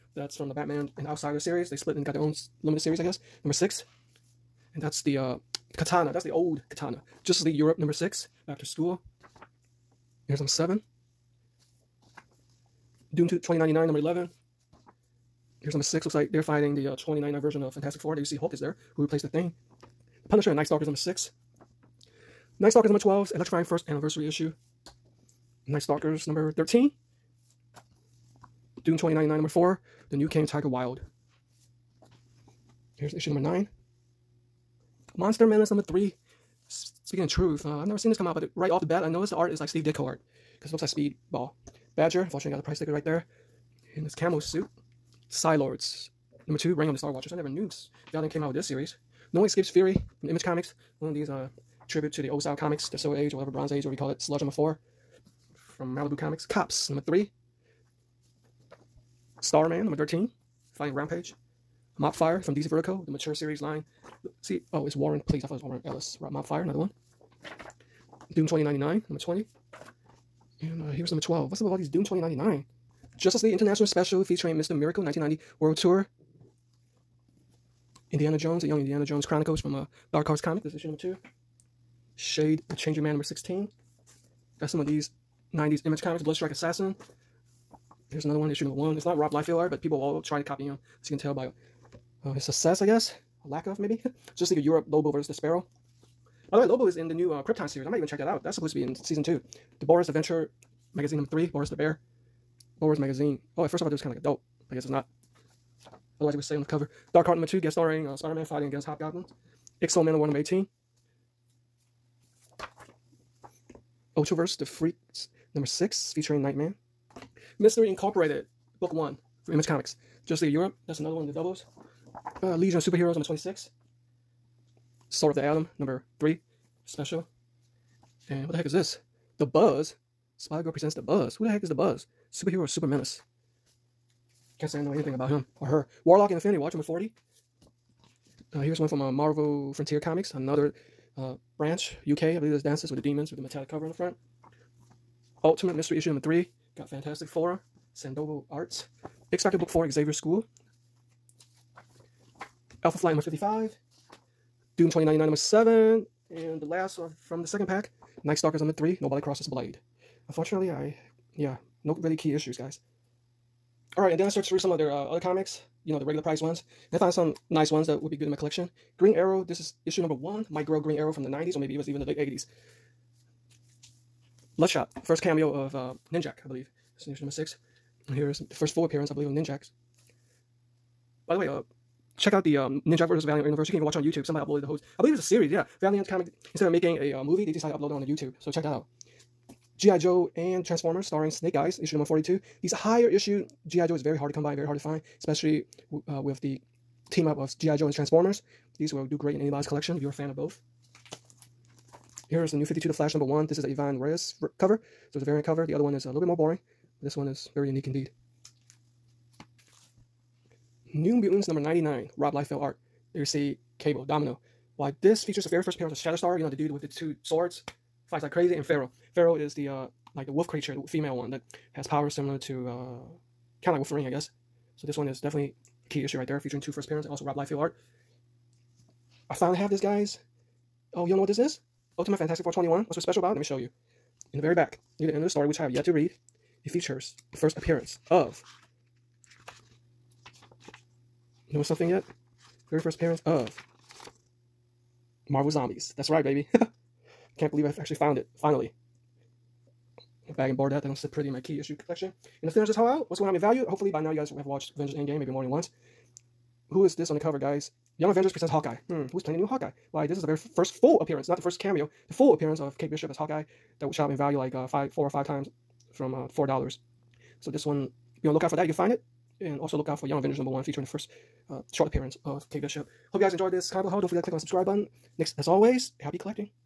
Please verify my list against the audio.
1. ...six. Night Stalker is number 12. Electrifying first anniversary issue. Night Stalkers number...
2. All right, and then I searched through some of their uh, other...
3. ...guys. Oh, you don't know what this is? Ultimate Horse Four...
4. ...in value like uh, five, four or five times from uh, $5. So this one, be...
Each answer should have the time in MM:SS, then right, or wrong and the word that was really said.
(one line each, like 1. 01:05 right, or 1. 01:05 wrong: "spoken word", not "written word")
1. 00:20 right
2. 02:43 right
3. 03:49 wrong: "Fantastic", not "Horse"
4. 04:24 wrong: "4", not "5".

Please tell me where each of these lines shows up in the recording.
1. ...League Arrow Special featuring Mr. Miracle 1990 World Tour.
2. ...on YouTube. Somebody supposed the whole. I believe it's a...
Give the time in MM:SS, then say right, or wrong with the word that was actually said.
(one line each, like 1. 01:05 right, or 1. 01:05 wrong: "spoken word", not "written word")
1. 01:13 wrong: "International", not "Arrow"
2. 03:03 wrong: "uploaded", not "supposed".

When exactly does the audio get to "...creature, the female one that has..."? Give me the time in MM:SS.
03:40.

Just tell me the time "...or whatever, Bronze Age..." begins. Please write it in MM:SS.
00:53.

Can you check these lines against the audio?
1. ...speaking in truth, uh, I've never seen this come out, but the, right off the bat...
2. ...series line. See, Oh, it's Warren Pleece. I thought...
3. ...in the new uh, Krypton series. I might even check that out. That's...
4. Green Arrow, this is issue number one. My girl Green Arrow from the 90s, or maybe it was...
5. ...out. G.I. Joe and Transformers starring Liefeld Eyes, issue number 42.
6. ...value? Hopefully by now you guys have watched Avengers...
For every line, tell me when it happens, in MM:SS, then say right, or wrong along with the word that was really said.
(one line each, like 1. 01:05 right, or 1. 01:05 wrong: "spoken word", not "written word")
1. 00:37 right
2. 01:03 right
3. 01:36 right
4. 02:48 right
5. 03:08 wrong: "Snake", not "Liefeld"
6. 04:13 right.